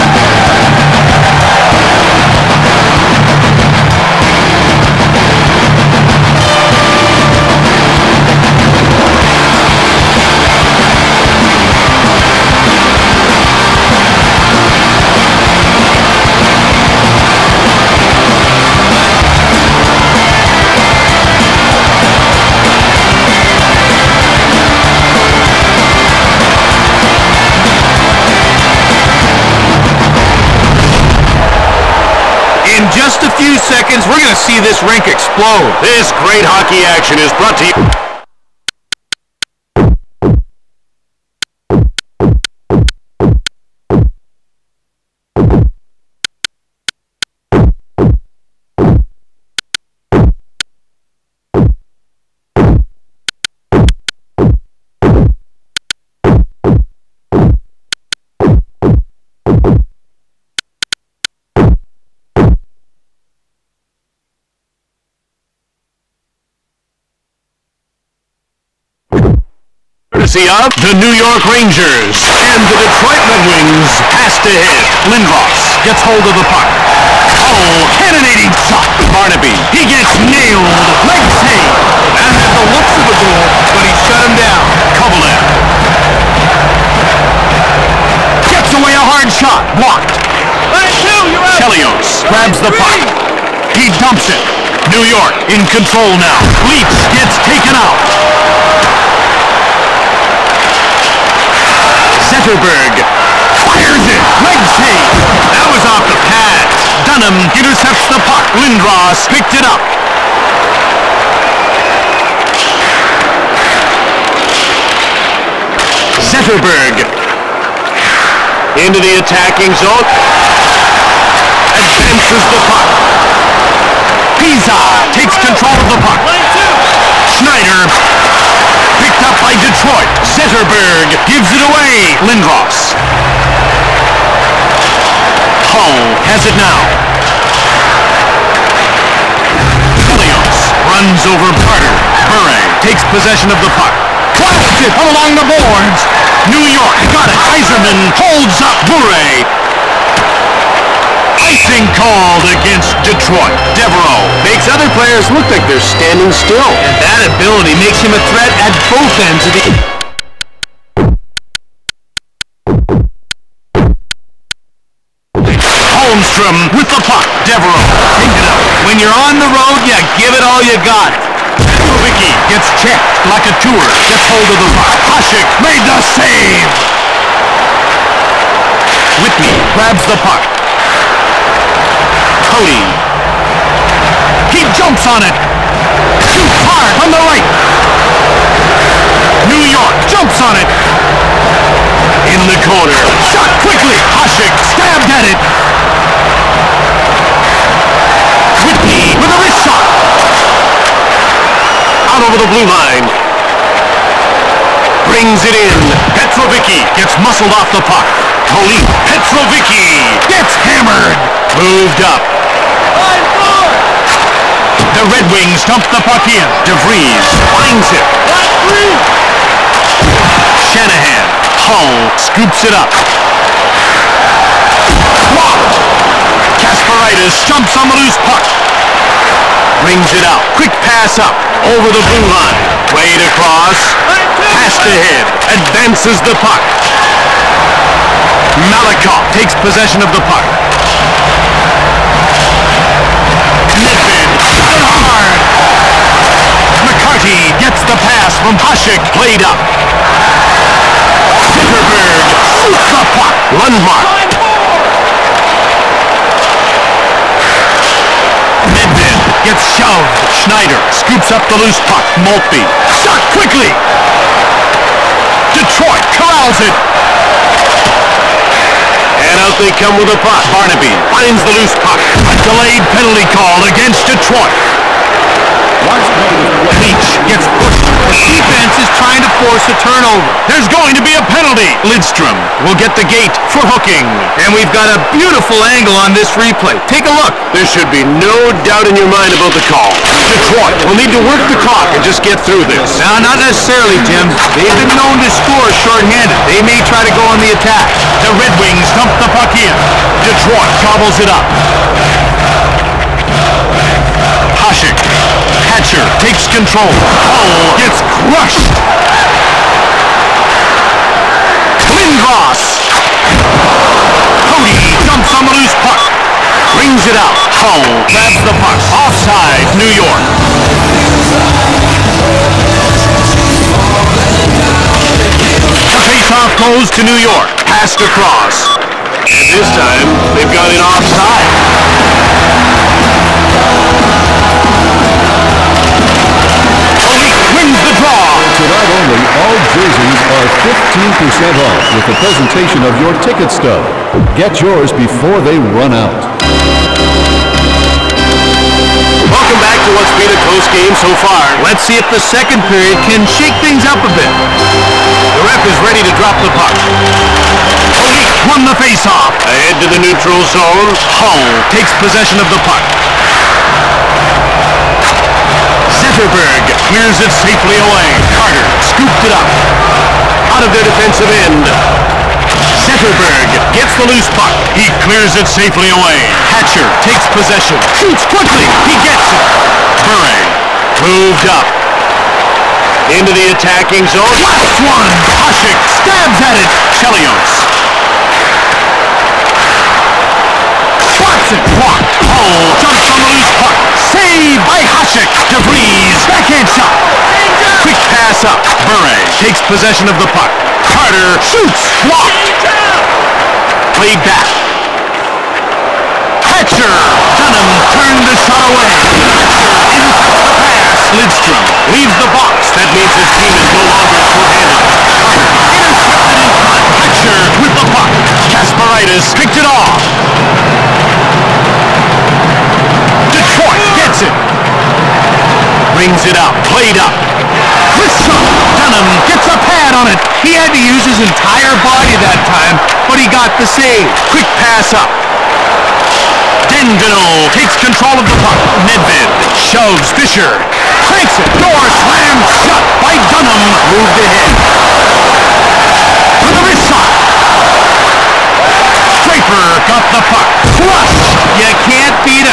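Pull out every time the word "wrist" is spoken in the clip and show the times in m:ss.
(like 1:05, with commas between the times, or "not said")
3:19, 7:26.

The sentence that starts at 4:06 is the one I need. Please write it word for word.
McCarty gets the pass from Hasek played up.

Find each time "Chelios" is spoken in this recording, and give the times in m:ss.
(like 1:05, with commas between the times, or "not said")
1:31, 2:20, 6:26.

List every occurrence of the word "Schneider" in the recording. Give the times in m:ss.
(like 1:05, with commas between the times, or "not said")
2:07, 4:20.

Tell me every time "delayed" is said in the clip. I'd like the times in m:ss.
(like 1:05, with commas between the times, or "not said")
4:32.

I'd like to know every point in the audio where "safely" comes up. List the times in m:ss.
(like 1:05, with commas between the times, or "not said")
6:07, 6:15.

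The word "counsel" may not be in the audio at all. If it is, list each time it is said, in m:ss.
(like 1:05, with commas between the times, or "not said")
not said.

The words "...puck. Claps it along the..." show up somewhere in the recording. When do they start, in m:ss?
2:23.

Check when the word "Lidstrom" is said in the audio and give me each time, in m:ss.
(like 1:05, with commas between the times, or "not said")
4:41, 6:51.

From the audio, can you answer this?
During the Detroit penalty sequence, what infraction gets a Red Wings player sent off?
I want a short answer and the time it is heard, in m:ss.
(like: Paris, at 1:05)
Hooking, at 4:43.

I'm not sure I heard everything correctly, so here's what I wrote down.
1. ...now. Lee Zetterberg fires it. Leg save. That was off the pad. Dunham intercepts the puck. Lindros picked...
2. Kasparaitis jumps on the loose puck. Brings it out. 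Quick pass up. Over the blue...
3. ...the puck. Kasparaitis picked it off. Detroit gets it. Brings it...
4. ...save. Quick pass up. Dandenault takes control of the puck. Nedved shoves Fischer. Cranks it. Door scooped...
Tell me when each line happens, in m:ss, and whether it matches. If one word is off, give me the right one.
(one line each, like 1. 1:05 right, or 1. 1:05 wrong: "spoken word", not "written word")
1. 1:36 right
2. 3:46 right
3. 6:57 right
4. 7:13 wrong: "slammed", not "scooped".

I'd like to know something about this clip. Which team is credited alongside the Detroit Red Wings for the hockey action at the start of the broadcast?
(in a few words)
New York Rangers.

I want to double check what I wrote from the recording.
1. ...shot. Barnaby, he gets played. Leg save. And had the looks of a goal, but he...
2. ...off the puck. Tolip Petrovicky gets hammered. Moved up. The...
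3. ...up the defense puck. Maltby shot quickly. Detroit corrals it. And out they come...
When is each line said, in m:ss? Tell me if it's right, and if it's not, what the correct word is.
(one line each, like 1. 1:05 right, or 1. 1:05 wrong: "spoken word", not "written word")
1. 1:18 wrong: "nailed", not "played"
2. 3:27 right
3. 4:21 wrong: "loose", not "defense".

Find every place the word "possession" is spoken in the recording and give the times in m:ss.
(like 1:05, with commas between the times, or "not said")
2:23, 3:59, 6:01, 6:17, 6:39.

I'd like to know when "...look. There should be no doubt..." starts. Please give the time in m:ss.
4:47.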